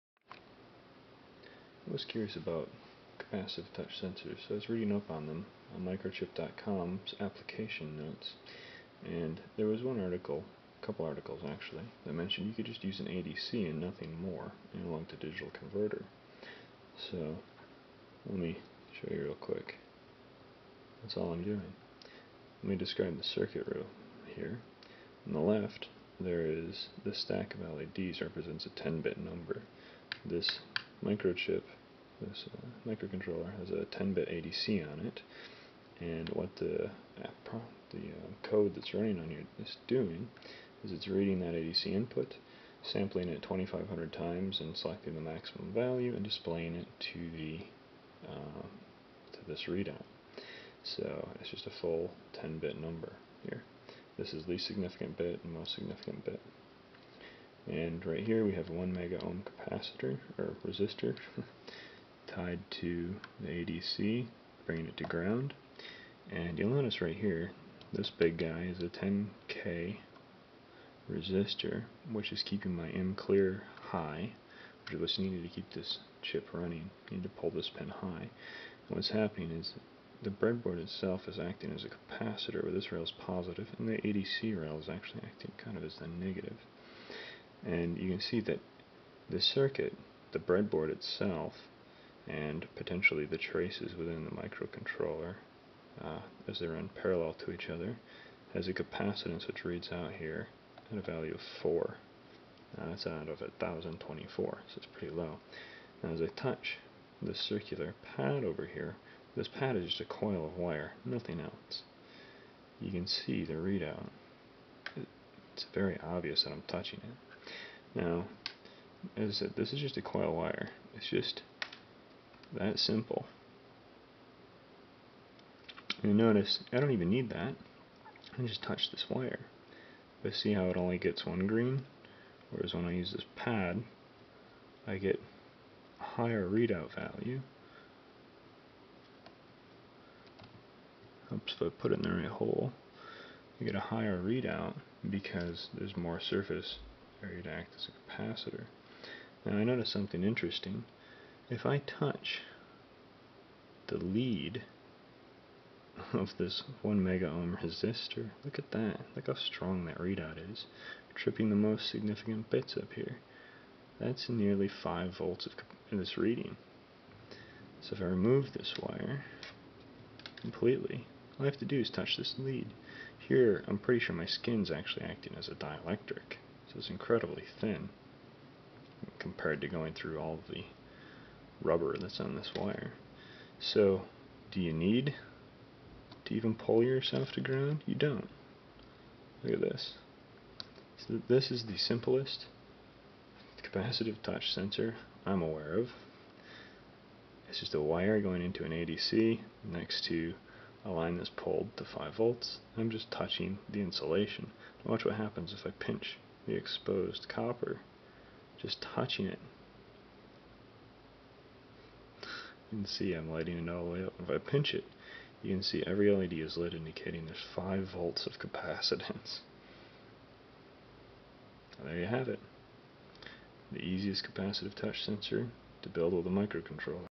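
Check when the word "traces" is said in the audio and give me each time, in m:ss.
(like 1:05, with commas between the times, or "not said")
1:33.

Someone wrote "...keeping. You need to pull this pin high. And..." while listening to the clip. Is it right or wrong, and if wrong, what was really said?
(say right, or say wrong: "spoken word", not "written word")
wrong: "running", not "keeping".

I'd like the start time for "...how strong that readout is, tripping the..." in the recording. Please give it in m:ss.
2:39.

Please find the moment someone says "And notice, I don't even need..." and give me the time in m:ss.
2:06.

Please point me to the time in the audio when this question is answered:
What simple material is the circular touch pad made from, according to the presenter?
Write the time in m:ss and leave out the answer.
1:50.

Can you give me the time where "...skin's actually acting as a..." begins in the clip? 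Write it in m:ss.
2:54.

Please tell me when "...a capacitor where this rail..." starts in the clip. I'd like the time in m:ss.
1:21.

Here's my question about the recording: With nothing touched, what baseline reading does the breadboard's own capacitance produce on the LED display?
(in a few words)
4.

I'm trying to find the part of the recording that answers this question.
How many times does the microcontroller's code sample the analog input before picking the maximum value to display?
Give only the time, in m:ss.
0:43.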